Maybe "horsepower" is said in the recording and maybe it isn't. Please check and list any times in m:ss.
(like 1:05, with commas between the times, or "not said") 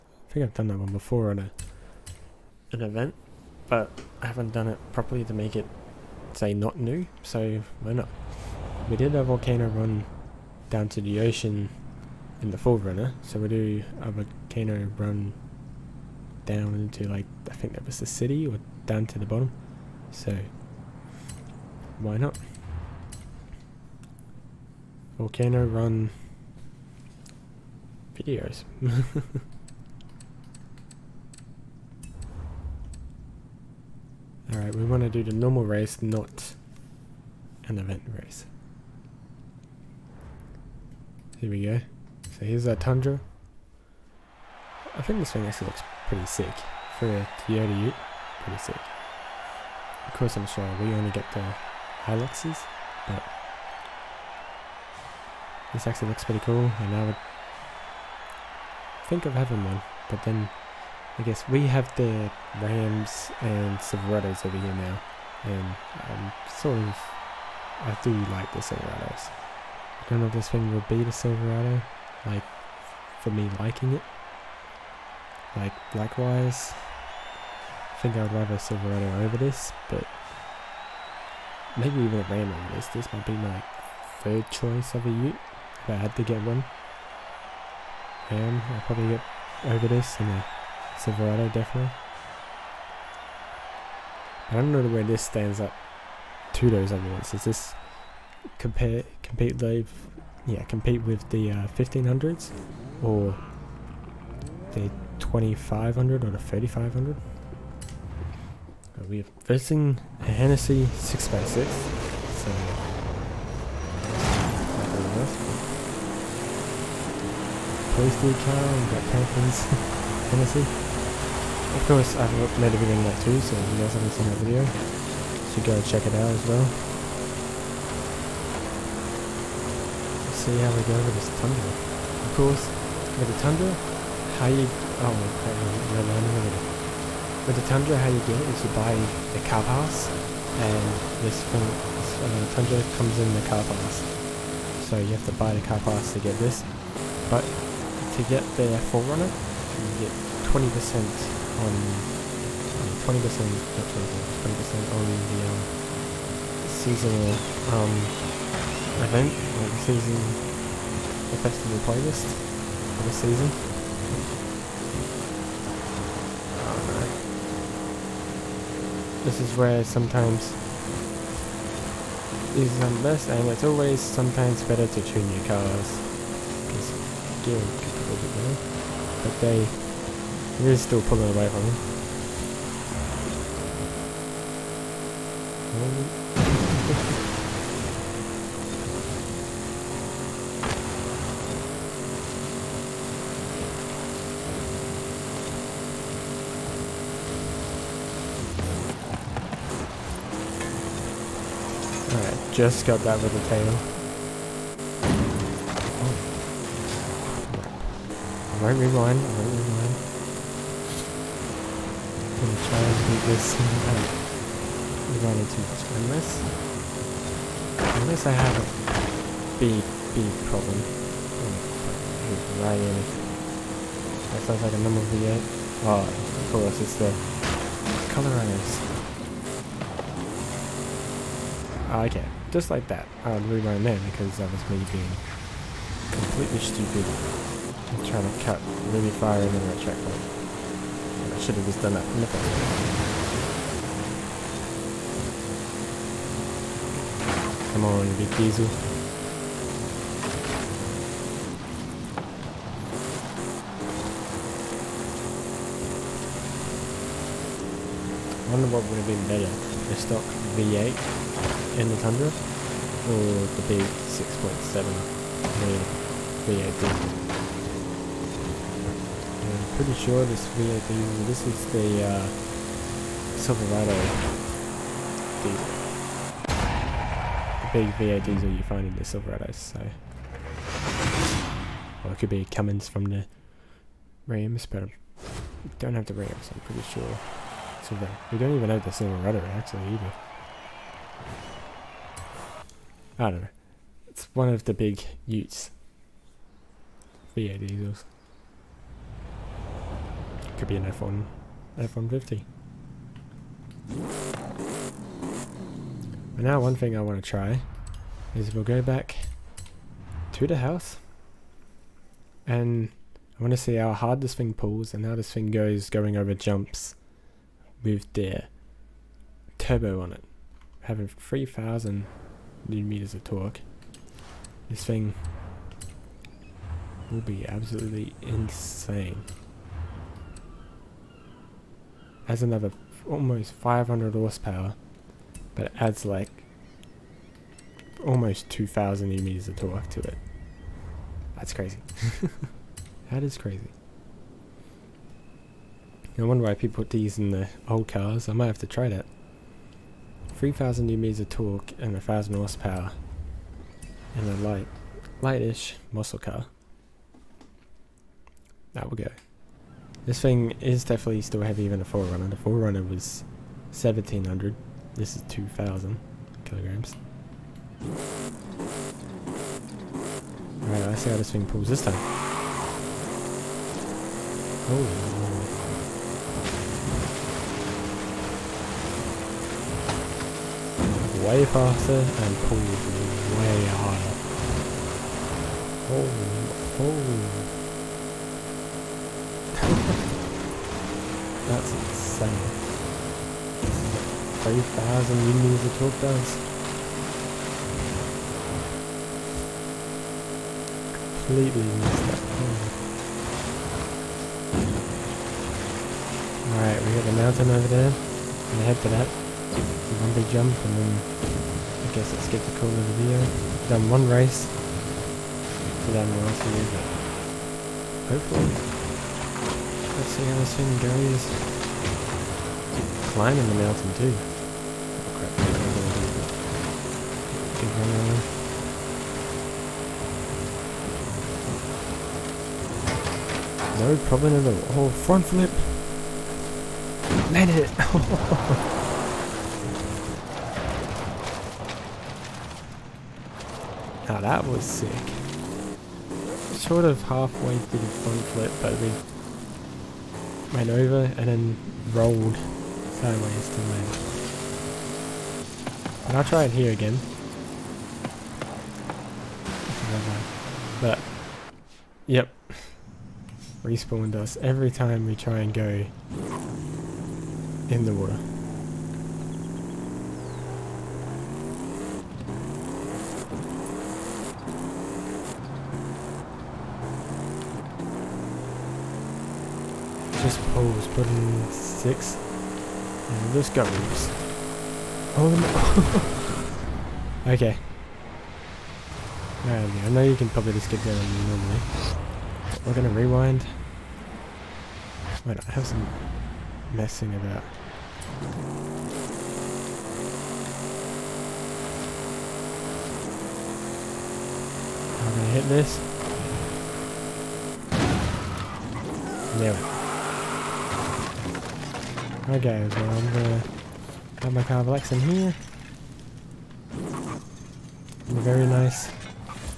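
5:34, 5:52.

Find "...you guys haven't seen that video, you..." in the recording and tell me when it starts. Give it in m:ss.
2:03.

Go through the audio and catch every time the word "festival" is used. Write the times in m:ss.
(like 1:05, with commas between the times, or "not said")
2:41.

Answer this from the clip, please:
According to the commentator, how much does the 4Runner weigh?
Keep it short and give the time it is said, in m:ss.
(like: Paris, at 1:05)
1700, at 6:03.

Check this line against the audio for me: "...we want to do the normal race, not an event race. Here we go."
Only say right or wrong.
right.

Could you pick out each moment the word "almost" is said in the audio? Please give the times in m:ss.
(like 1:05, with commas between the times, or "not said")
5:33, 5:38.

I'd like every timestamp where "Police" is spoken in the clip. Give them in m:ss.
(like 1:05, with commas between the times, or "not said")
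1:57.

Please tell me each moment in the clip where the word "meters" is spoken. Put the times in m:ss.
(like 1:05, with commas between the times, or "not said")
5:22, 5:39, 5:50.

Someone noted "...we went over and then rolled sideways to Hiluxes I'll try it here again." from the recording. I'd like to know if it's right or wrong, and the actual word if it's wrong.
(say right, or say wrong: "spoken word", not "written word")
wrong: "And", not "Hiluxes".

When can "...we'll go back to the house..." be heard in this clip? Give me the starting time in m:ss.
5:08.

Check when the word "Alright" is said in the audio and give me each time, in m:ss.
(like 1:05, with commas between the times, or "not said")
0:34, 3:22, 6:10, 6:46.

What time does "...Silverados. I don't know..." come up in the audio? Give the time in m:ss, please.
1:08.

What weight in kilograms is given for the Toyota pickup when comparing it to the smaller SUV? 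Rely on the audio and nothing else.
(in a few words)
2000 kilograms.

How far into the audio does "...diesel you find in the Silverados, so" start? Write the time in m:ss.
4:38.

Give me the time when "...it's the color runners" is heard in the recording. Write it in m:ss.
3:46.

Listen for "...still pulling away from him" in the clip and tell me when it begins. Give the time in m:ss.
3:00.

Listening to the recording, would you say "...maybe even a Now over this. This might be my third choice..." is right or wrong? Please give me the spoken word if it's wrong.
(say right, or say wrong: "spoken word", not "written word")
wrong: "Ram", not "Now".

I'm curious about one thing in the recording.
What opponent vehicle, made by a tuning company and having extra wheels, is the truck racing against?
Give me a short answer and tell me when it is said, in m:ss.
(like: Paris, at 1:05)
Hennessy 6x6, at 1:50.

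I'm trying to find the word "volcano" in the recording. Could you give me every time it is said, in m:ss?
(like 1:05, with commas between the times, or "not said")
0:09, 0:14, 0:25.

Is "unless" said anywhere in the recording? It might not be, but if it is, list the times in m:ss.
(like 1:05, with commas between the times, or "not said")
3:38.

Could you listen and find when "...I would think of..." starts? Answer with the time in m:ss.
0:56.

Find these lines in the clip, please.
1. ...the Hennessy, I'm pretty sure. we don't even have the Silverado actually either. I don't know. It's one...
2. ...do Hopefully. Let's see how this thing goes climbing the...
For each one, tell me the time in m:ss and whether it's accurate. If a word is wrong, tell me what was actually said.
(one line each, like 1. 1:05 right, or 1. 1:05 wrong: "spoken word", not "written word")
1. 4:46 wrong: "Rams", not "Hennessy"
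2. 6:56 right.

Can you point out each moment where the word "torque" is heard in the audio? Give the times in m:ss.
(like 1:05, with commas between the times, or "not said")
5:23, 5:39, 5:51, 6:35.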